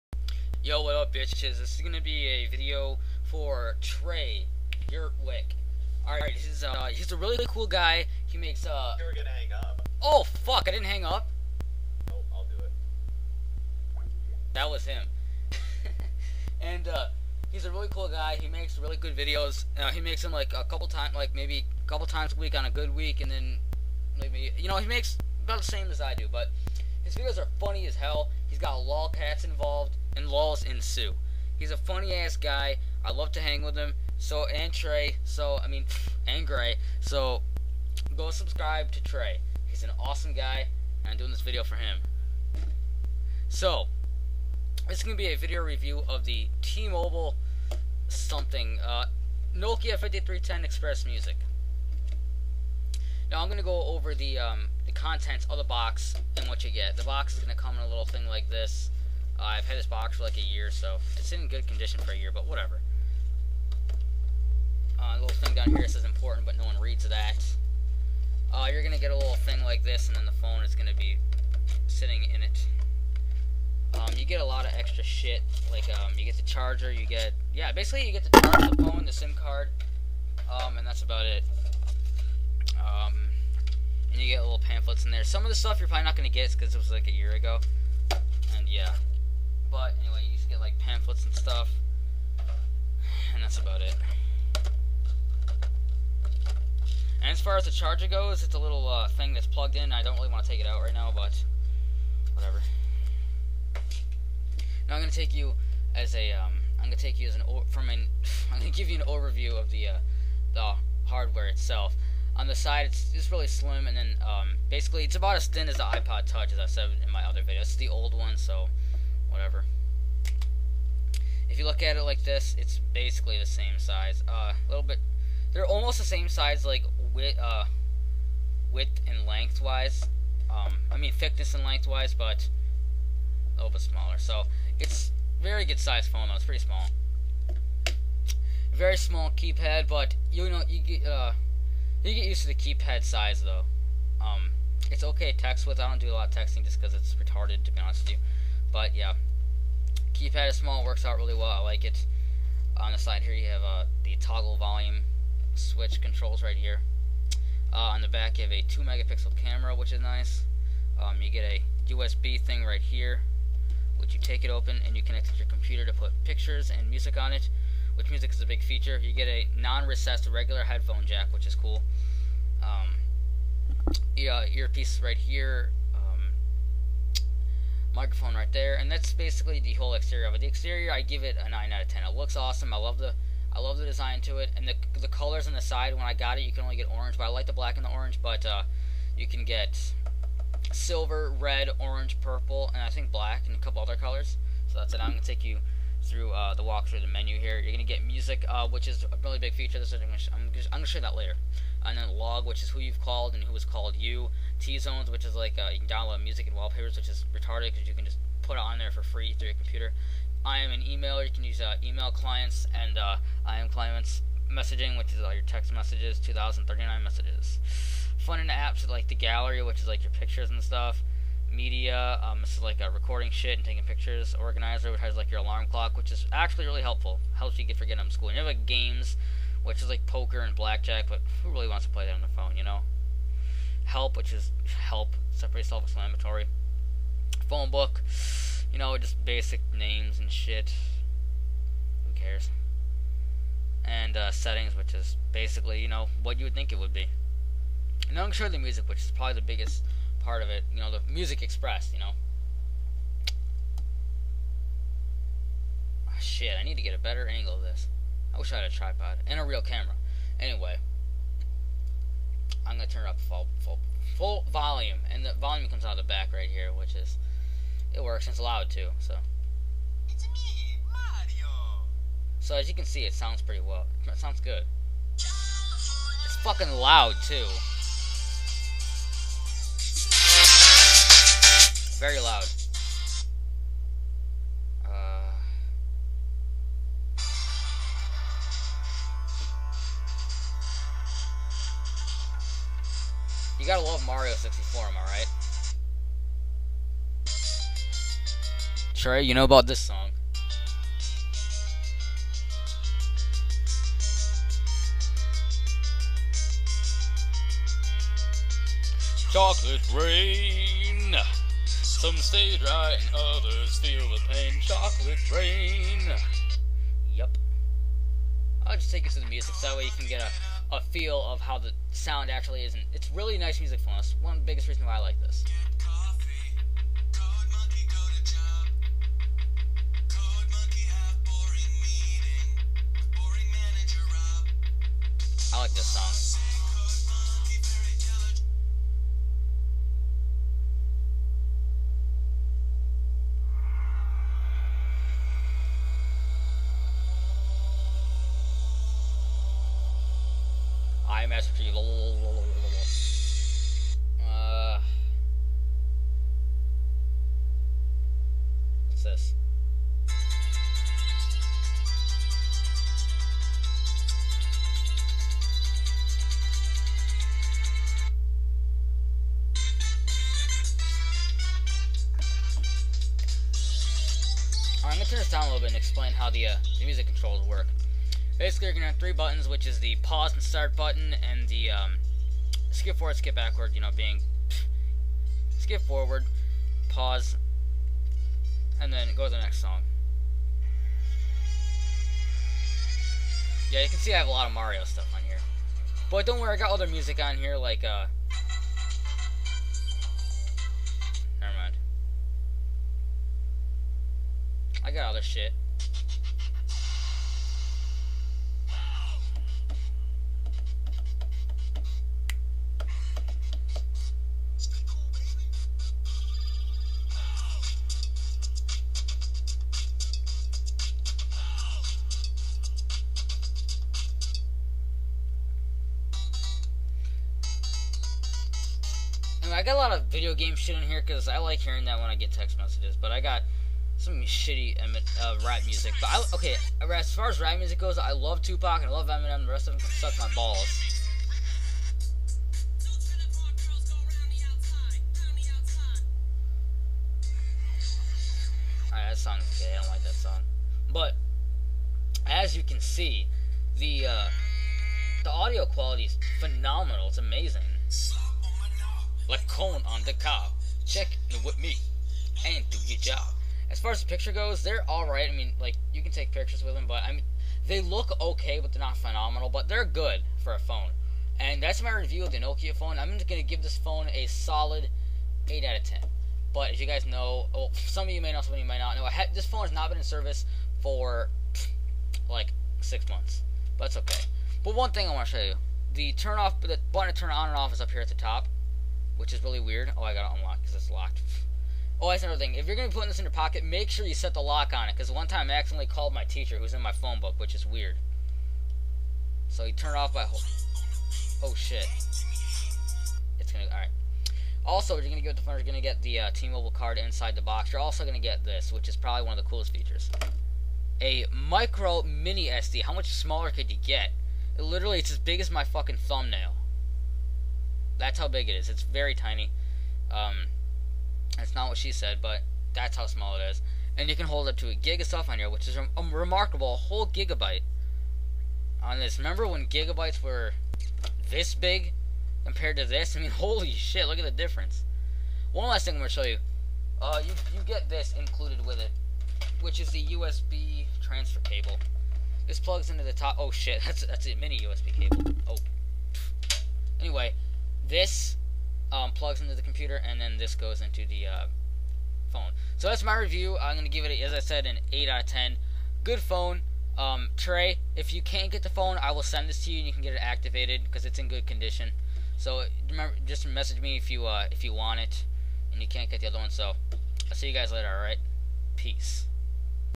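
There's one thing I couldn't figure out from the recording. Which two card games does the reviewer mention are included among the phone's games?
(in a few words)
poker and blackjack.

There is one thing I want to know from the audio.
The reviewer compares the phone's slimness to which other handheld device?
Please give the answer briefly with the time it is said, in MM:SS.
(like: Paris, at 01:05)
iPod Touch, at 01:55.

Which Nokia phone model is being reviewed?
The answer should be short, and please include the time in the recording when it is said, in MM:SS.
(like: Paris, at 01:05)
5310 XpressMusic, at 00:49.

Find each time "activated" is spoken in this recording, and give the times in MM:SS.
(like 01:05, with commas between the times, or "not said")
09:20.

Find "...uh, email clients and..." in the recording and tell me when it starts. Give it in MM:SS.
03:31.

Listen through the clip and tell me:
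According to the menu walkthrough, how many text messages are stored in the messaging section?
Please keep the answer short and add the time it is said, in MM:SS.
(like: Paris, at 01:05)
2039, at 03:36.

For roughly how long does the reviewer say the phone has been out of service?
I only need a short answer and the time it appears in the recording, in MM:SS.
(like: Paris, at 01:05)
six months, at 08:02.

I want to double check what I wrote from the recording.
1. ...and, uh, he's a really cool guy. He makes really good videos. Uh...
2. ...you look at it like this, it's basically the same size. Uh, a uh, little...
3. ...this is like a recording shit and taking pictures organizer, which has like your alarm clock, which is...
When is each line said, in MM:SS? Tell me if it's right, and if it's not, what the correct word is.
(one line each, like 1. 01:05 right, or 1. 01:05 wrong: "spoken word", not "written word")
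1. 00:16 right
2. 02:01 right
3. 03:42 right.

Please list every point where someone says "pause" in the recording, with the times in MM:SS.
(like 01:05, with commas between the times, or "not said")
06:19, 06:26.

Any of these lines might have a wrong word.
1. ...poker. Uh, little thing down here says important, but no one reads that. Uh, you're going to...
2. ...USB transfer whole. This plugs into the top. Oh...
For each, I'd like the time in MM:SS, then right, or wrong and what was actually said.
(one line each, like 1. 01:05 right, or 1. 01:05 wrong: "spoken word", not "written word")
1. 01:02 wrong: "whatever", not "poker"
2. 09:00 wrong: "cable", not "whole".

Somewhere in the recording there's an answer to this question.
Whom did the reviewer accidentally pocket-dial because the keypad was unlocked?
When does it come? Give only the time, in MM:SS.
08:16.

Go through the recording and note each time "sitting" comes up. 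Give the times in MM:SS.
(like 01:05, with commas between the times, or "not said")
01:11.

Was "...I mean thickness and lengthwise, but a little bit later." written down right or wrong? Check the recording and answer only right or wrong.
wrong.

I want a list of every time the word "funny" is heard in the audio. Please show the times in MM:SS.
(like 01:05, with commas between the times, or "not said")
00:27, 00:31.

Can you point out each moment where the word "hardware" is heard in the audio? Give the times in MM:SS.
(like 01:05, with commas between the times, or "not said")
01:51.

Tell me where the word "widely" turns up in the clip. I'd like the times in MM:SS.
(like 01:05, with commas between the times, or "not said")
not said.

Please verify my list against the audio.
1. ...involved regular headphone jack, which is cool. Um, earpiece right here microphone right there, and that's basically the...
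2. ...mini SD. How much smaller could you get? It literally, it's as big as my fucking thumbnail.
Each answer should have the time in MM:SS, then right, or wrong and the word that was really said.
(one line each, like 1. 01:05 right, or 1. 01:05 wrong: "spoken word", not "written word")
1. 02:49 wrong: "recessed", not "involved"
2. 08:32 right.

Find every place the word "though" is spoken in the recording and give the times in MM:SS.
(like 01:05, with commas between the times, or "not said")
02:16, 02:23.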